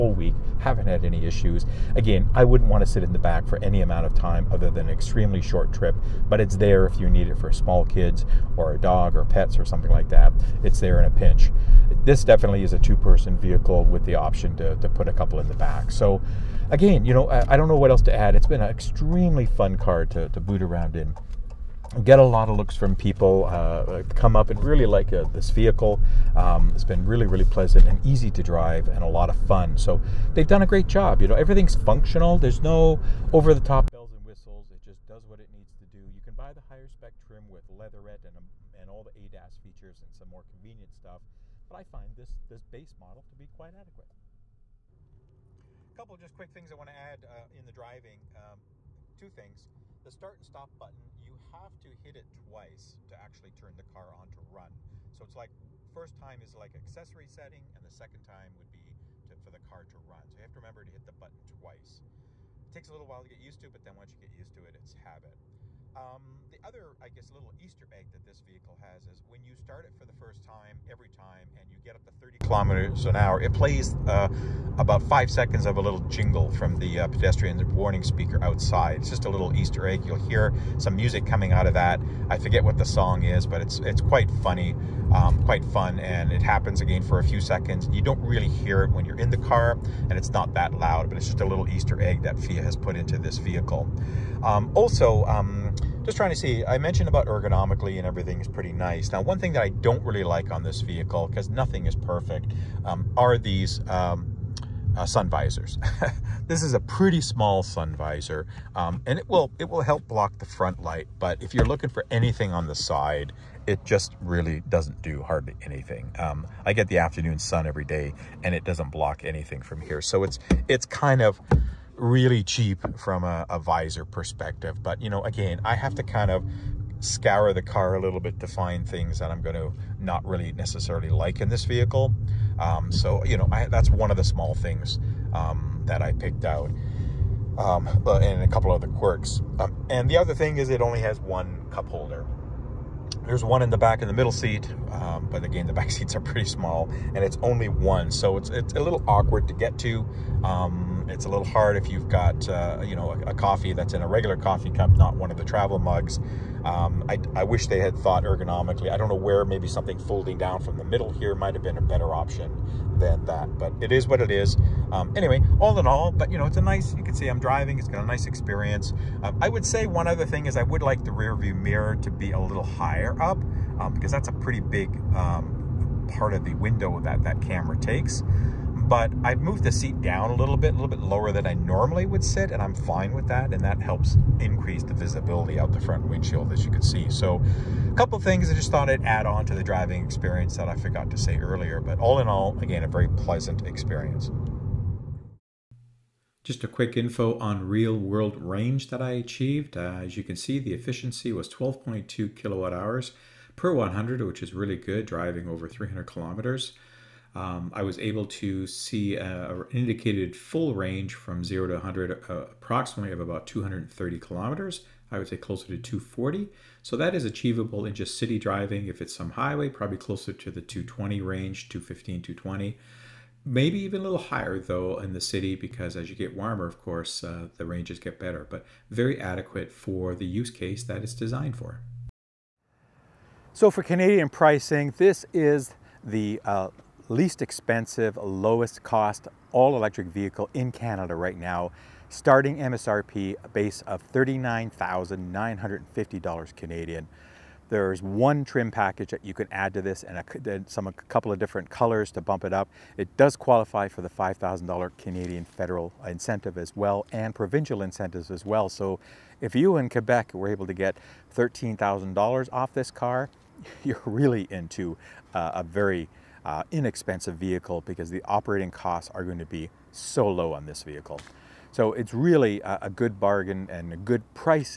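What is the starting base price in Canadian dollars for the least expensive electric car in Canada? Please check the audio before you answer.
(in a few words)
$39,950.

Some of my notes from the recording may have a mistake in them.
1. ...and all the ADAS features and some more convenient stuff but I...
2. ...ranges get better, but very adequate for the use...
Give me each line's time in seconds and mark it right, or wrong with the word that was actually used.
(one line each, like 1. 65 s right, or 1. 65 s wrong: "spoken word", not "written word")
1. 38 s right
2. 227 s right.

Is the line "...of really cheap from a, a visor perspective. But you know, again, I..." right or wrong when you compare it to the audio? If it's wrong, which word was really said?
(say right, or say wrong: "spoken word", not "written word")
right.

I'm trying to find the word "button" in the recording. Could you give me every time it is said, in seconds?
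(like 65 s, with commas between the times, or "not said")
50 s, 61 s.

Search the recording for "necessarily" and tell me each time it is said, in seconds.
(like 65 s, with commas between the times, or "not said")
130 s.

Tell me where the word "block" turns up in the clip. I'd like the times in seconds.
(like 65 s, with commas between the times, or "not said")
110 s, 118 s.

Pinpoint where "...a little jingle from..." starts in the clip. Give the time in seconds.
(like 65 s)
75 s.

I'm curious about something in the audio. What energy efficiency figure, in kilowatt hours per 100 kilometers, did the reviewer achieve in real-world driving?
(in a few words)
12.2.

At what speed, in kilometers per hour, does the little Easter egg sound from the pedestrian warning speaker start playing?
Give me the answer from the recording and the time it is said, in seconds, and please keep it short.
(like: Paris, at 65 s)
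30, at 72 s.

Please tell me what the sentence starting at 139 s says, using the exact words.
Um, and the other thing is, it only has one cup holder.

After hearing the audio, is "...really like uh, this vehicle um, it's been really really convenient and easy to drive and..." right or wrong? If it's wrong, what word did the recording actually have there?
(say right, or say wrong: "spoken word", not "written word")
wrong: "pleasant", not "convenient".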